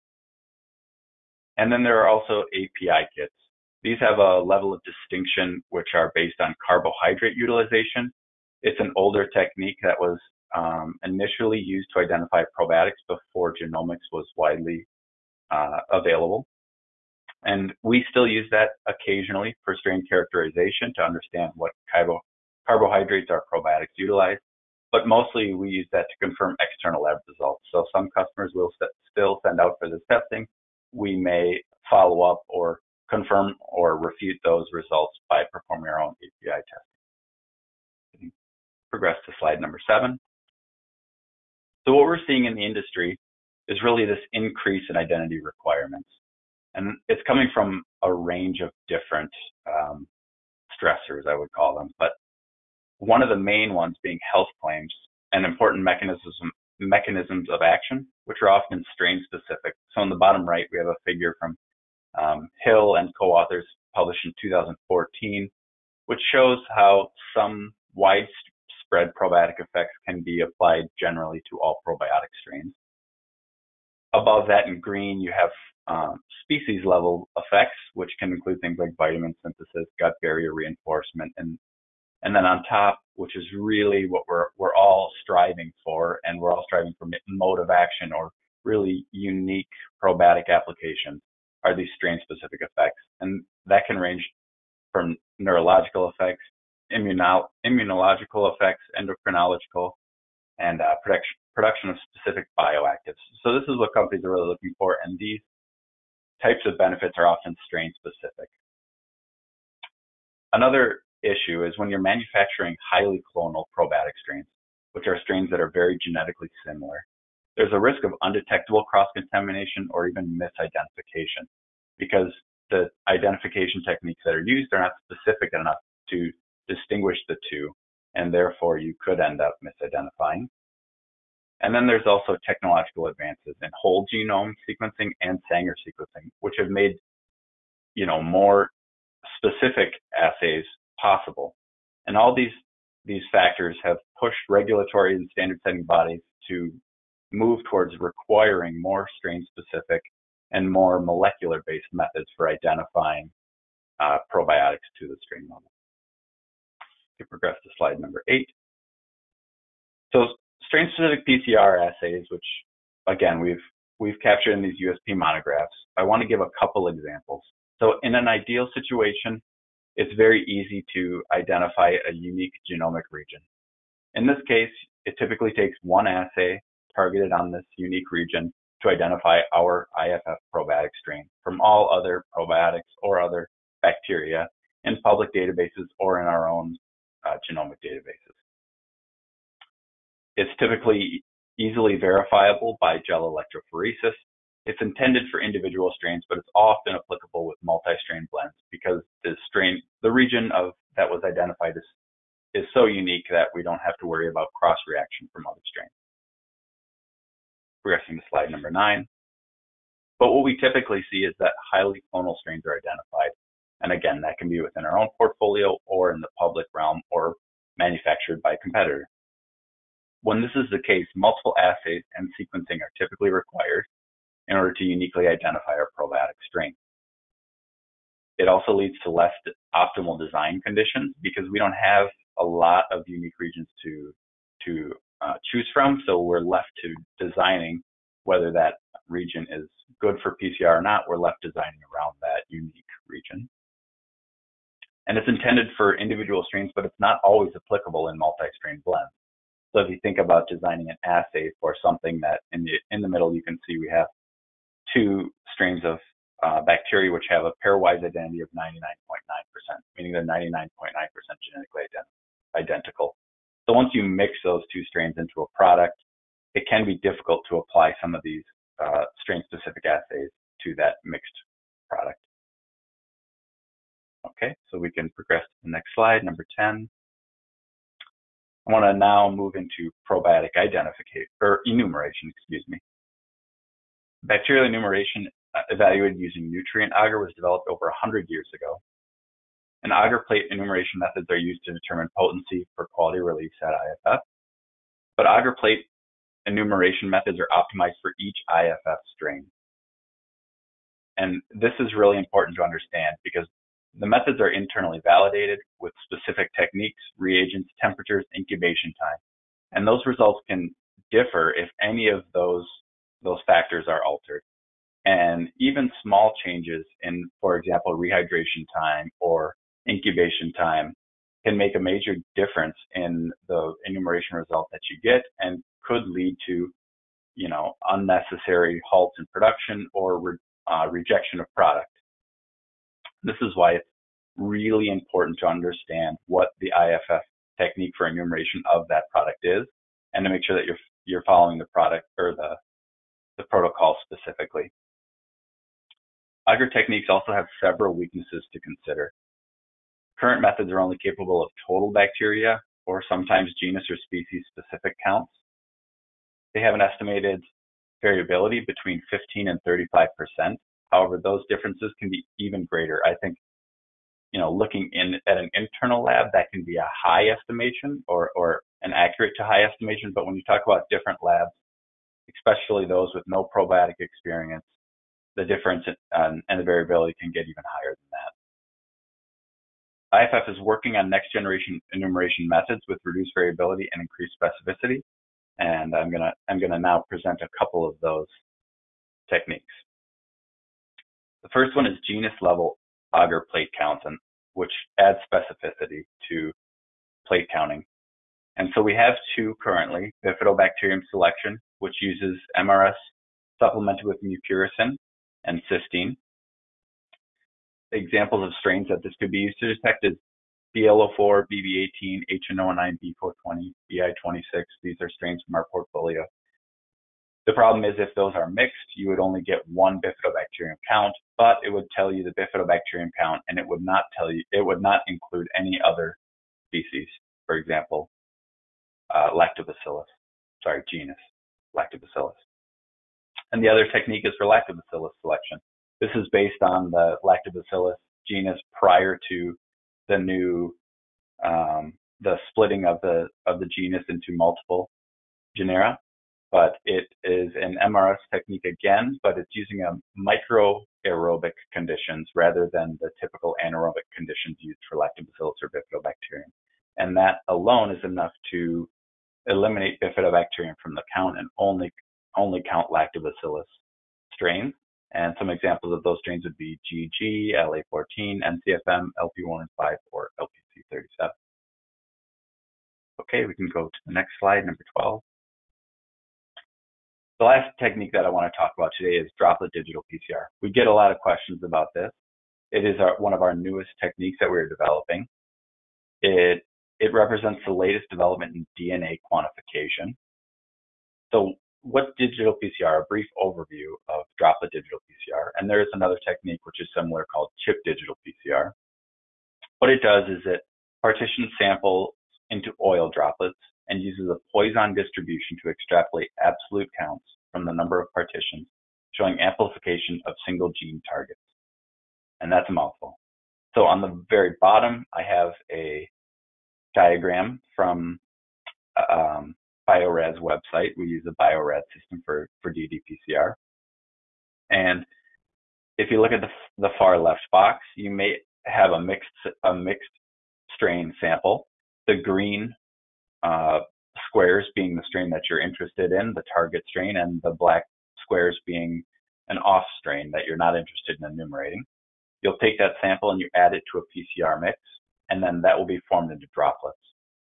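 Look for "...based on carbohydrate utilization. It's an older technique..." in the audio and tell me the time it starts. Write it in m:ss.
0:06.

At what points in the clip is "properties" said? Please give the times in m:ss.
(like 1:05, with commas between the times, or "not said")
not said.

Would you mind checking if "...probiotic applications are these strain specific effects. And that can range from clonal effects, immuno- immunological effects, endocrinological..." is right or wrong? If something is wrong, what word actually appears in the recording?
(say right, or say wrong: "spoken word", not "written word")
wrong: "neurological", not "clonal".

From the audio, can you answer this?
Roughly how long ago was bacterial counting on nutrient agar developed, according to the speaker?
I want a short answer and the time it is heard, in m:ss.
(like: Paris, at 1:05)
Over 100 years, at 4:47.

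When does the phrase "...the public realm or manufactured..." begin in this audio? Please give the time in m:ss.
3:36.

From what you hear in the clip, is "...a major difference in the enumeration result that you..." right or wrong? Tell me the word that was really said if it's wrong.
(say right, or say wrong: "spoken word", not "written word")
right.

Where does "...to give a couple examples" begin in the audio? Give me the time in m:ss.
2:46.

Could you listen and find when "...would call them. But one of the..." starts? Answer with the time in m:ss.
0:51.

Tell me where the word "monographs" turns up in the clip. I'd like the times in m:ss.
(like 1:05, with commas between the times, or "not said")
2:45.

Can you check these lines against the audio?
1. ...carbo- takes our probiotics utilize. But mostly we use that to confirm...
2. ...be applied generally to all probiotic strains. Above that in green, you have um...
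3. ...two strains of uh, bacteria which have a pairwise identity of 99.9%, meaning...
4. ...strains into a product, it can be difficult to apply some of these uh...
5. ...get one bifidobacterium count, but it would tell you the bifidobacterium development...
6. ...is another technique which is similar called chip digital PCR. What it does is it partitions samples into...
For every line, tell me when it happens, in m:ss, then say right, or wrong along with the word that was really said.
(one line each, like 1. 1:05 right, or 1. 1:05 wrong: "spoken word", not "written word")
1. 0:21 wrong: "carbohydrates", not "takes"
2. 1:10 right
3. 4:14 right
4. 4:24 right
5. 6:59 wrong: "count", not "development"
6. 8:15 right.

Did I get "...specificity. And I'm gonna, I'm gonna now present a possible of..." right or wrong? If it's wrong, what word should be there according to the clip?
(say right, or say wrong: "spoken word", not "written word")
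wrong: "couple", not "possible".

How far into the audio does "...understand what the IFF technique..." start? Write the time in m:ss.
5:35.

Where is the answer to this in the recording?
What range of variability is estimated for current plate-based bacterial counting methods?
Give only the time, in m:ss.
5:58.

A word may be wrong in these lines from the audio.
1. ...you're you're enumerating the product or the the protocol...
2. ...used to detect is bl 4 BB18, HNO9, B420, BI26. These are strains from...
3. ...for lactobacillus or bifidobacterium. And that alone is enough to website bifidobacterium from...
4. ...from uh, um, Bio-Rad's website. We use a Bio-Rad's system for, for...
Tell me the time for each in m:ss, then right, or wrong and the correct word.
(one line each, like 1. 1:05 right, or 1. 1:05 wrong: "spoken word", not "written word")
1. 5:40 wrong: "following", not "enumerating"
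2. 6:49 right
3. 7:34 wrong: "eliminate", not "website"
4. 8:37 right.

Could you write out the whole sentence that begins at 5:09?
And those results can differ if any of those, those factors are altered.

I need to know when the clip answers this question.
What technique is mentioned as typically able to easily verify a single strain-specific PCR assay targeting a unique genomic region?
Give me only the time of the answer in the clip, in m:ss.
3:13.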